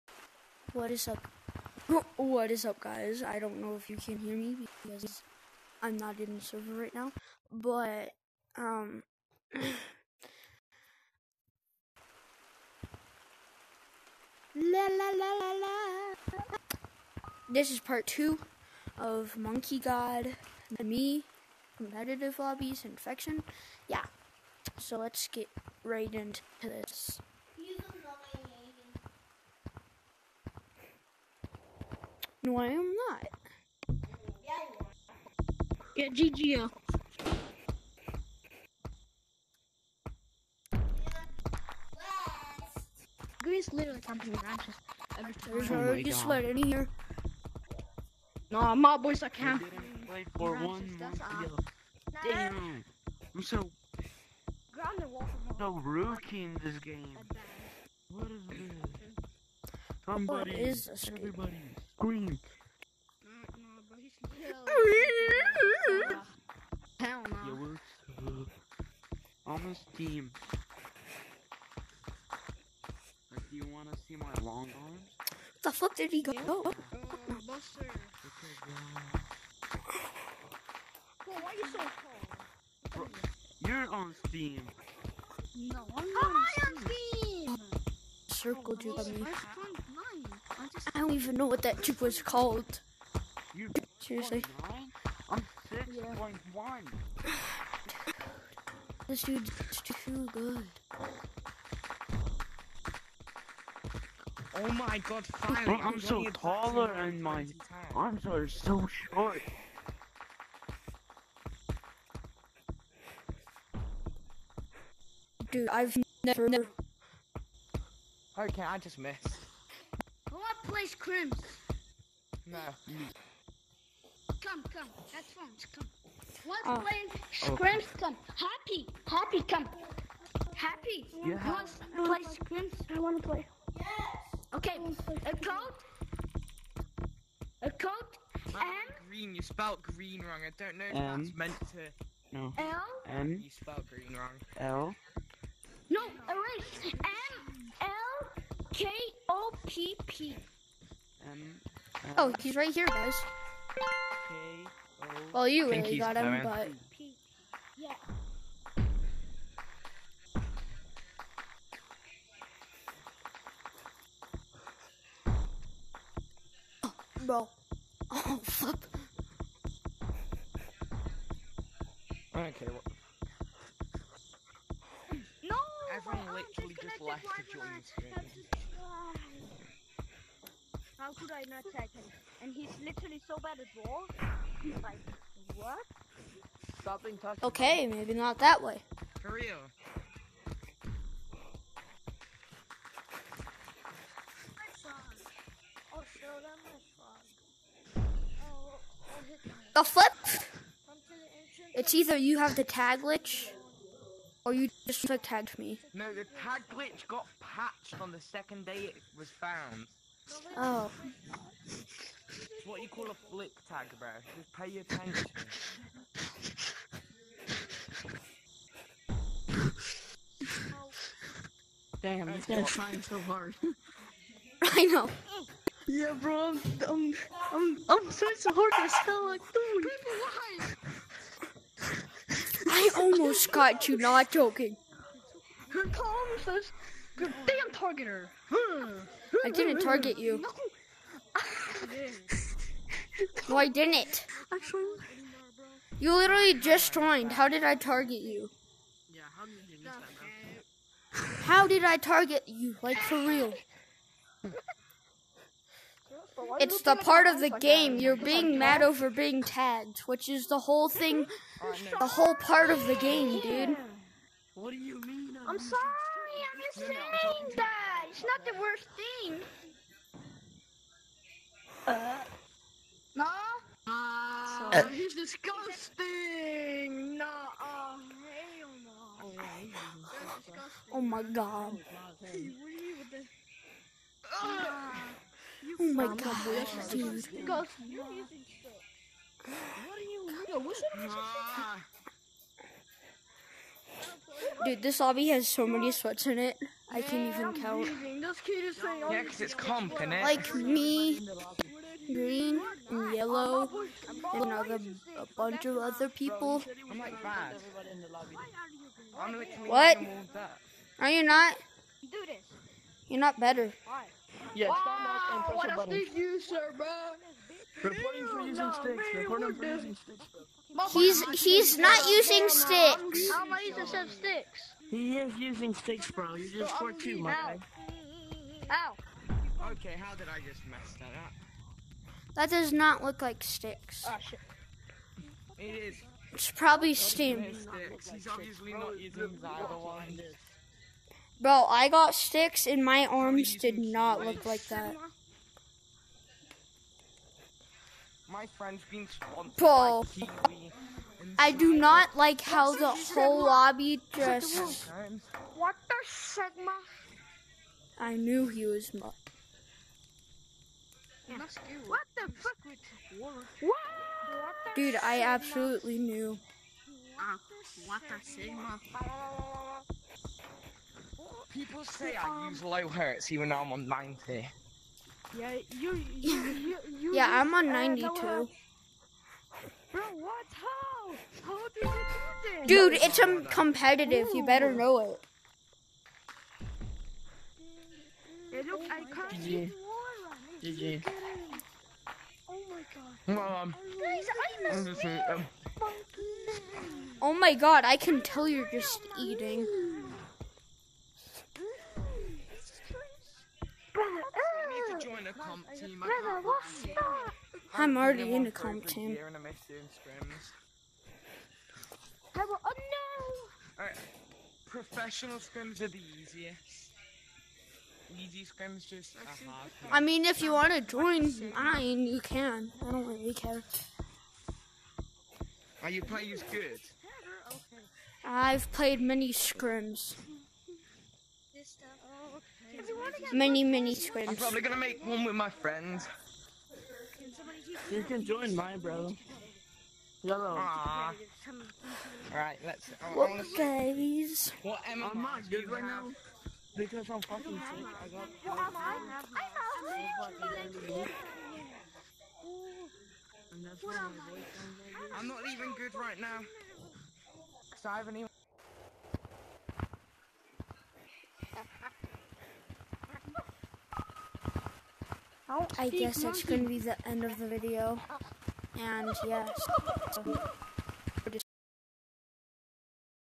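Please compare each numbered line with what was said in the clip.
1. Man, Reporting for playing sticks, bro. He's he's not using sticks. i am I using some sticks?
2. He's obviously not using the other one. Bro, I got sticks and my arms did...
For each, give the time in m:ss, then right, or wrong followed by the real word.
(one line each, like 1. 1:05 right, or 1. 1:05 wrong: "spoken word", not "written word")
1. 5:19 wrong: "using", not "playing"
2. 5:37 right.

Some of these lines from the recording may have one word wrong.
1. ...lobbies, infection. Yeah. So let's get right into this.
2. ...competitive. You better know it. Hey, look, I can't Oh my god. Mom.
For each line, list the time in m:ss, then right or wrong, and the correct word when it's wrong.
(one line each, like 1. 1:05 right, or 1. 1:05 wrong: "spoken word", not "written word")
1. 0:22 right
2. 6:23 right.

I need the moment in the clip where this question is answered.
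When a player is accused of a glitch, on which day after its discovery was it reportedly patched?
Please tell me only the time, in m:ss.
3:28.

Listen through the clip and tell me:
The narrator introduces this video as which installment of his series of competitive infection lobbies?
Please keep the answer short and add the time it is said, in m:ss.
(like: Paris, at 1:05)
Part two, at 0:17.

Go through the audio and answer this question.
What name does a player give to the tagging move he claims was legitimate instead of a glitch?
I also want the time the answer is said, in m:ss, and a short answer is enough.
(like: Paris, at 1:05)
Flip tag, at 3:33.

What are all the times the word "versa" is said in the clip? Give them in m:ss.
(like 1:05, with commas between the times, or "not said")
not said.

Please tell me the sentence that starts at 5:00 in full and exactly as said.
Like me, green, and yellow, and another, a bunch of other people.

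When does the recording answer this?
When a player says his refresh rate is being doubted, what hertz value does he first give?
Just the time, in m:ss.
6:13.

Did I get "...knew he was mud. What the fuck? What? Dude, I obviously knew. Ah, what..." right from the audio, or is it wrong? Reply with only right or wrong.
wrong.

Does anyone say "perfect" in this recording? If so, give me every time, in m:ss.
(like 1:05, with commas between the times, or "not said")
not said.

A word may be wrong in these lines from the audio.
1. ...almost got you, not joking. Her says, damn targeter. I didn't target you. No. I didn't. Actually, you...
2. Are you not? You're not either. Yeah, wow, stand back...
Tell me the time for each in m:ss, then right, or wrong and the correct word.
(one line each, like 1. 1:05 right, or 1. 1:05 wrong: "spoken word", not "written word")
1. 3:52 right
2. 5:10 wrong: "better", not "either".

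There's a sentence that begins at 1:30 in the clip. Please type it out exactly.
I don't even know what that juke was called.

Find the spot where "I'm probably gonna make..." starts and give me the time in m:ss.
7:14.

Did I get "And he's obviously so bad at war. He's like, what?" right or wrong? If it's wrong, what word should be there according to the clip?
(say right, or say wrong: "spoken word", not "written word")
wrong: "literally", not "obviously".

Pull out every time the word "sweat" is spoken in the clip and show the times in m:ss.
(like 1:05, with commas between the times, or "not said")
0:46, 4:55.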